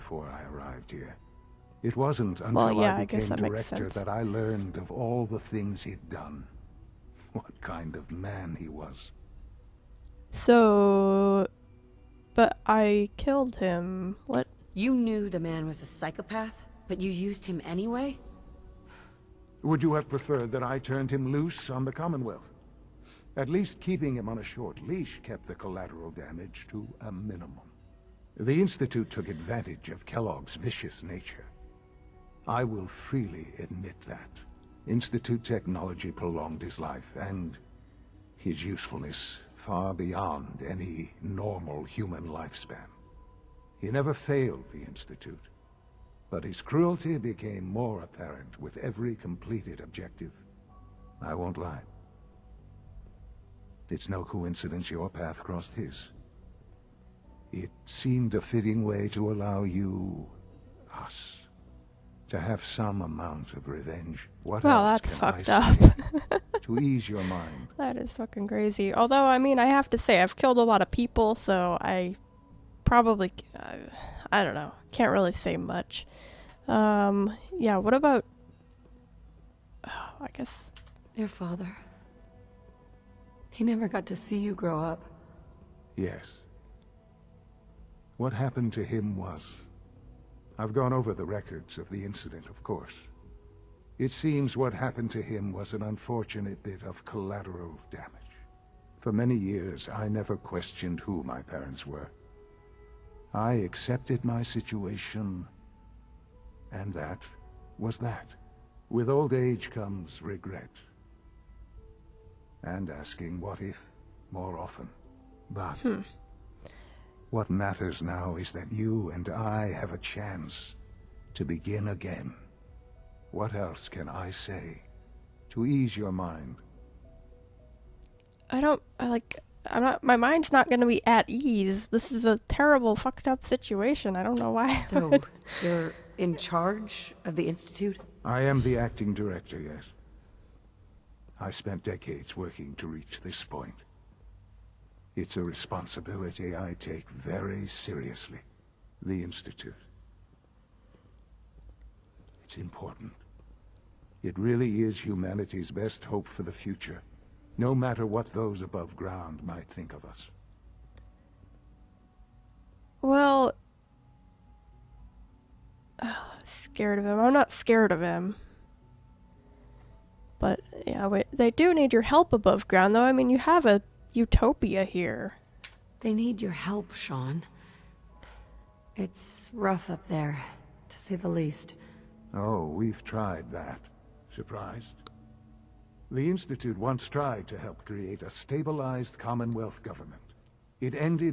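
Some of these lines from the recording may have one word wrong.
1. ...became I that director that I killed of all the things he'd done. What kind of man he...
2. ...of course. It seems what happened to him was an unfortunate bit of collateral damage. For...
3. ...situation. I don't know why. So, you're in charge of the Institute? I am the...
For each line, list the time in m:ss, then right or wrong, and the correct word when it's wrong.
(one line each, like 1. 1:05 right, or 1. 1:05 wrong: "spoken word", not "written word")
1. 0:03 wrong: "learned", not "killed"
2. 1:32 right
3. 2:13 right.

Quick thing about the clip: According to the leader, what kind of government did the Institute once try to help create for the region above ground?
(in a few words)
Stabilized Commonwealth government.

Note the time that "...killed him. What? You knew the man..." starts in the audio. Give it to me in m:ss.
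0:13.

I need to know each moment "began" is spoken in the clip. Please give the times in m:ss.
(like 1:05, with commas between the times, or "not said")
not said.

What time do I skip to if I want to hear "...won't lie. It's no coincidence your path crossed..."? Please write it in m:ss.
0:51.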